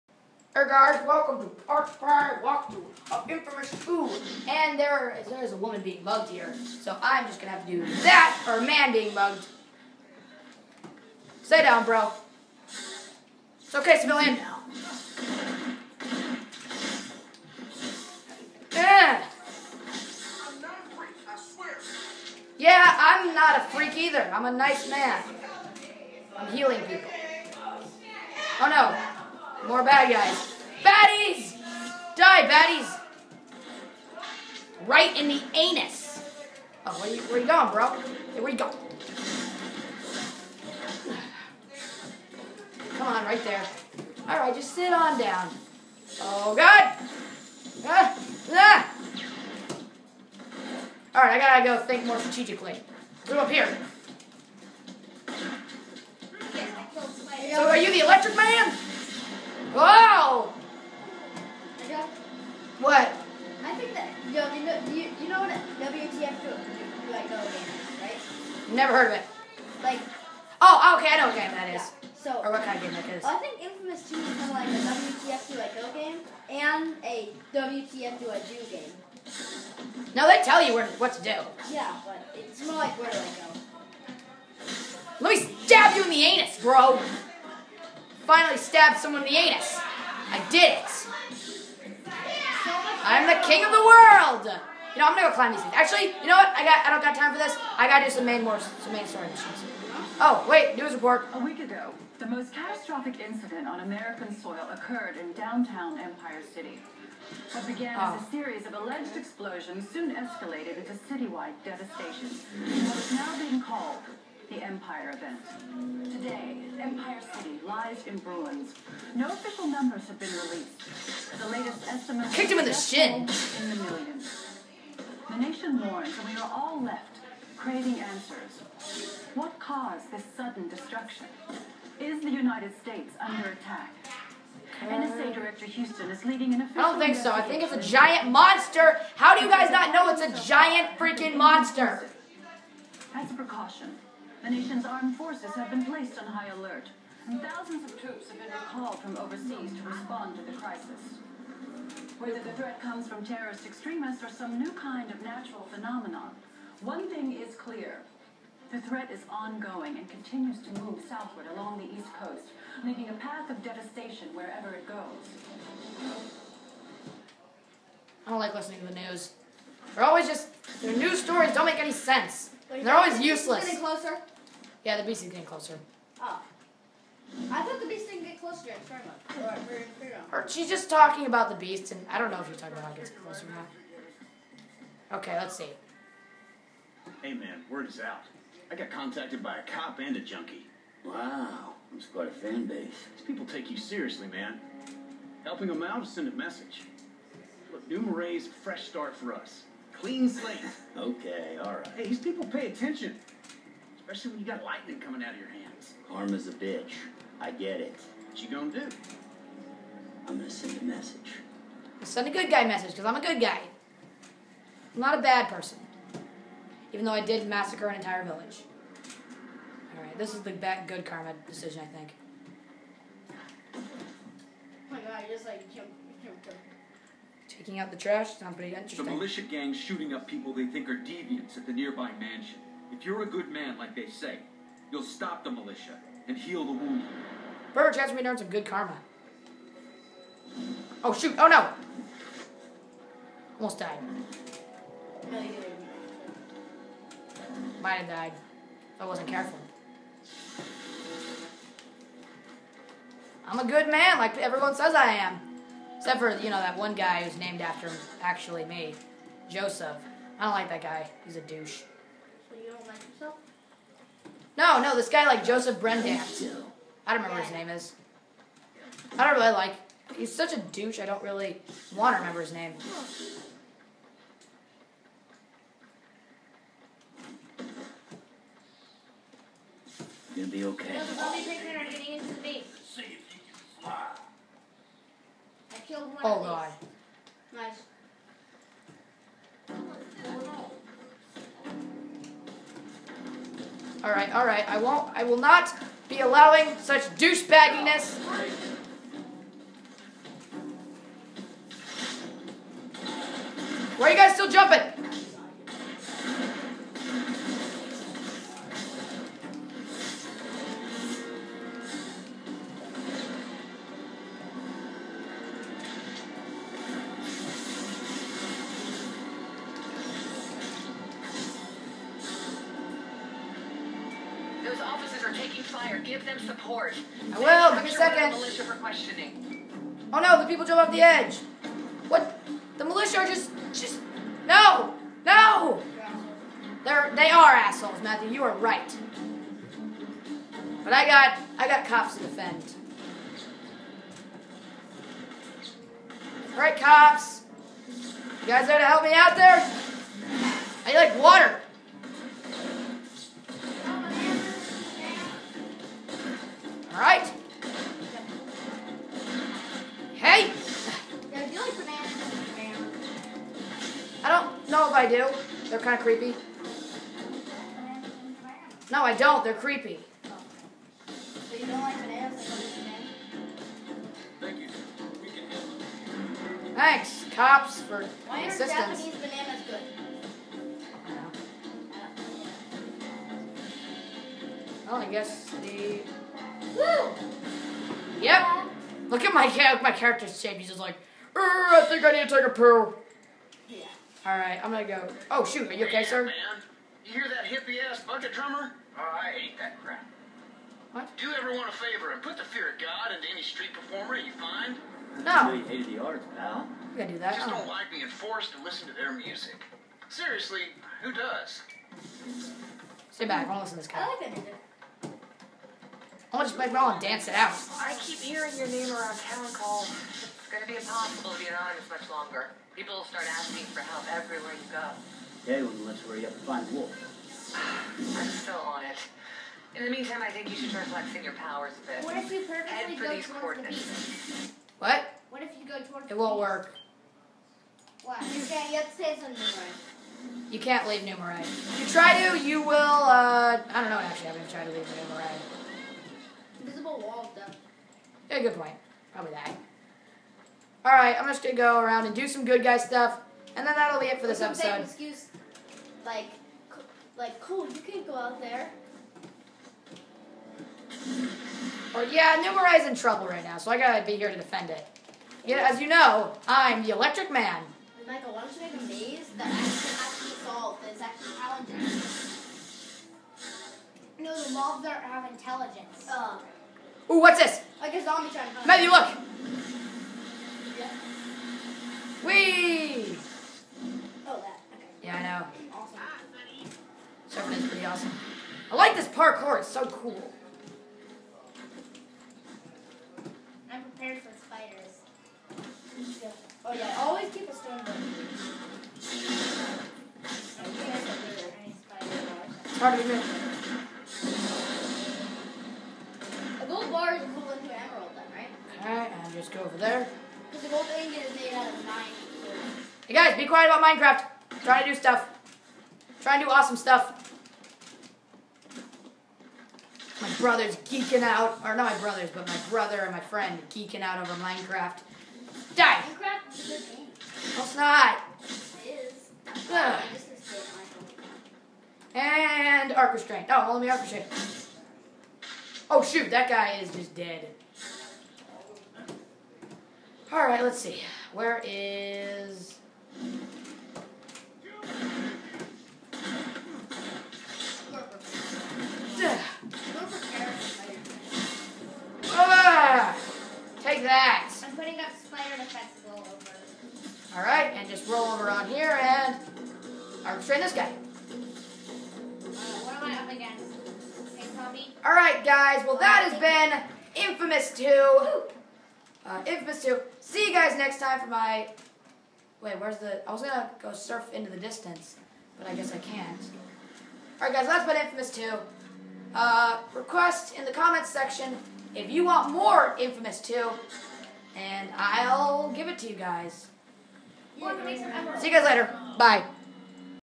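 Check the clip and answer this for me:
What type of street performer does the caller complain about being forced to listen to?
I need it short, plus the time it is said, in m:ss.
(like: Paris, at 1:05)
Bucket drummer, at 6:38.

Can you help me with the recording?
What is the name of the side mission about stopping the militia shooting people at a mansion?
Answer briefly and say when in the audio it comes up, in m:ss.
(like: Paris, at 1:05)
Taking out the trash, at 3:47.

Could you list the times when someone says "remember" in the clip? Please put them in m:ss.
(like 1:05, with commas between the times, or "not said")
4:27, 4:32.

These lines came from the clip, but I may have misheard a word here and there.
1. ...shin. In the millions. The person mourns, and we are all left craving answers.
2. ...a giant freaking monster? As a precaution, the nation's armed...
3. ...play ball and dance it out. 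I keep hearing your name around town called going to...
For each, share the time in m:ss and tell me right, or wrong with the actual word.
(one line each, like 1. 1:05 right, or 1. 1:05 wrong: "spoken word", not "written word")
1. 2:02 wrong: "nation", not "person"
2. 2:20 right
3. 6:56 right.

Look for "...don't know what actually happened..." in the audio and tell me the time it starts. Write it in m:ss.
7:23.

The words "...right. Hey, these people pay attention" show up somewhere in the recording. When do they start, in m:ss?
3:21.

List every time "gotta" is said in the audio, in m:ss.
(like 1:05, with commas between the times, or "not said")
0:51, 1:37, 6:46, 7:43.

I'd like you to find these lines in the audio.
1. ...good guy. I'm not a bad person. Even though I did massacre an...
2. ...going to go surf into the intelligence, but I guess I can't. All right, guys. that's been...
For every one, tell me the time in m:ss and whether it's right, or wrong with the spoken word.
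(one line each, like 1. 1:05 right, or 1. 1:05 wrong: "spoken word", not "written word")
1. 3:33 right
2. 9:33 wrong: "distance", not "intelligence".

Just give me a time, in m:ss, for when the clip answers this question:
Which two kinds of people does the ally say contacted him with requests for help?
3:09.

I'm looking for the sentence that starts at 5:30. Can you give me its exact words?
Oh no, the people jump off the edge.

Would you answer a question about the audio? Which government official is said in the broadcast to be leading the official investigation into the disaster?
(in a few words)
NSA Director Houston.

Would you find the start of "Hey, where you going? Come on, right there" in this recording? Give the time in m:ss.
0:38.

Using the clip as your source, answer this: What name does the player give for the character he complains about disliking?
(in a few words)
Joseph Brendan.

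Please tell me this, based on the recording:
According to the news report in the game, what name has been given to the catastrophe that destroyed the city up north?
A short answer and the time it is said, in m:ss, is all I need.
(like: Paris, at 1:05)
The Empire event, at 1:54.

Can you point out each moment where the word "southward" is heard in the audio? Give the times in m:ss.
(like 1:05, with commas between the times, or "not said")
2:41.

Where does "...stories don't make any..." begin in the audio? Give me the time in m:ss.
2:51.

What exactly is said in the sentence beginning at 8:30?
Because the gold ingot is made out of nine.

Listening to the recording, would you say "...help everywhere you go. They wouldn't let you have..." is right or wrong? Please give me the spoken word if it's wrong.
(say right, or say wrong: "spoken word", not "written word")
right.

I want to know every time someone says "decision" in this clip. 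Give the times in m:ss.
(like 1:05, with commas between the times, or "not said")
3:41.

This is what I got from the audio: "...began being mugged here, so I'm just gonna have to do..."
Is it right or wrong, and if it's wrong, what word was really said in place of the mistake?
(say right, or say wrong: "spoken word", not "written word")
wrong: "woman", not "began".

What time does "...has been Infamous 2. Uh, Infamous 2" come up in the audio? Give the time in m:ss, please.
9:26.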